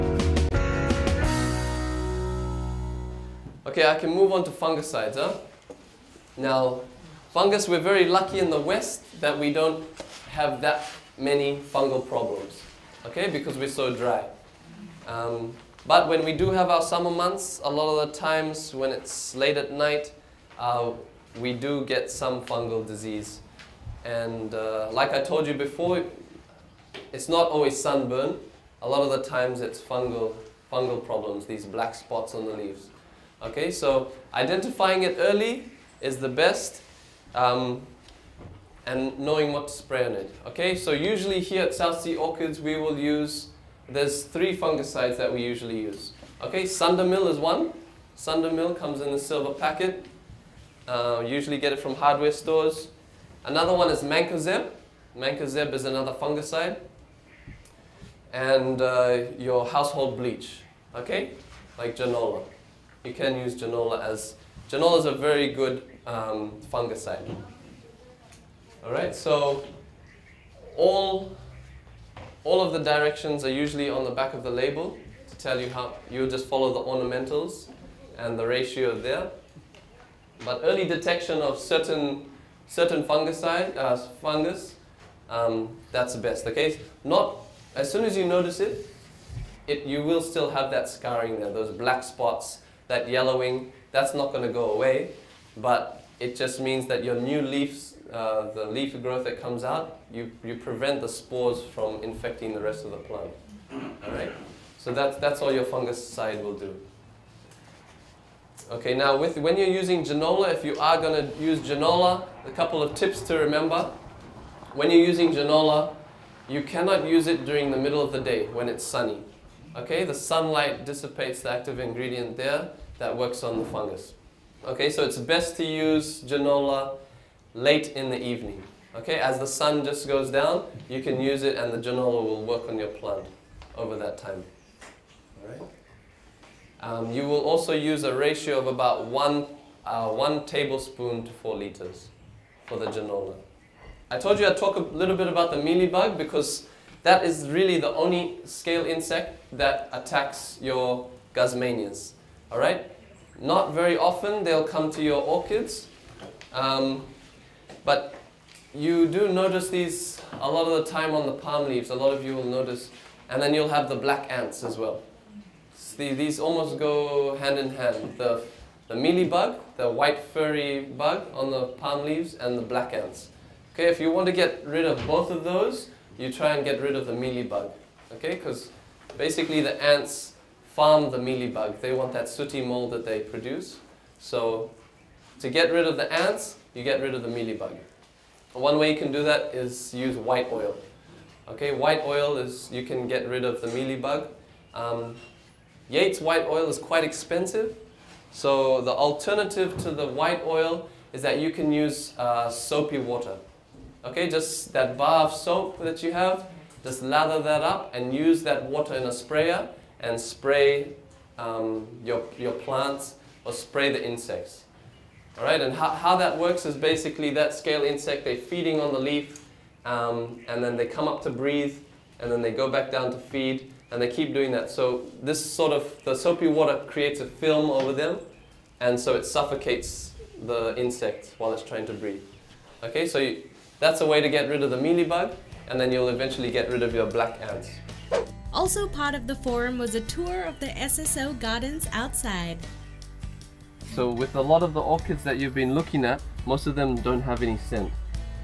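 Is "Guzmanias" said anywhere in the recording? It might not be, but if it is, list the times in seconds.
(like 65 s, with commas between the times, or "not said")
151 s.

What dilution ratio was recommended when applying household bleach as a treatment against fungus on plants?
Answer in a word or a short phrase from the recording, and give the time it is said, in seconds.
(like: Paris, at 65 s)
1 tablespoon to 4 liters, at 140 s.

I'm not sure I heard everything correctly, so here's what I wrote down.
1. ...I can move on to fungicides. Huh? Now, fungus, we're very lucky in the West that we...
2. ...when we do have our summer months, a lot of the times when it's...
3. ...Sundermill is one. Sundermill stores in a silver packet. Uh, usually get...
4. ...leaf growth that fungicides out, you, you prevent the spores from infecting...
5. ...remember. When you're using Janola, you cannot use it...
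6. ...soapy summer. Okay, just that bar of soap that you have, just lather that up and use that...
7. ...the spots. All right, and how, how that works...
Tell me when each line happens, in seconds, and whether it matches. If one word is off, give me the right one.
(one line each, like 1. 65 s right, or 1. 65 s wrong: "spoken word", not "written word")
1. 3 s right
2. 16 s right
3. 46 s wrong: "comes", not "stores"
4. 98 s wrong: "comes", not "fungicides"
5. 113 s right
6. 202 s wrong: "water", not "summer"
7. 213 s wrong: "insects", not "spots".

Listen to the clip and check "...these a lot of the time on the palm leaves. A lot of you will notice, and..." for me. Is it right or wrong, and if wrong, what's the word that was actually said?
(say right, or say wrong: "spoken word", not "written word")
right.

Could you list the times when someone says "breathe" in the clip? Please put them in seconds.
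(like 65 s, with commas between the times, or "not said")
221 s, 231 s.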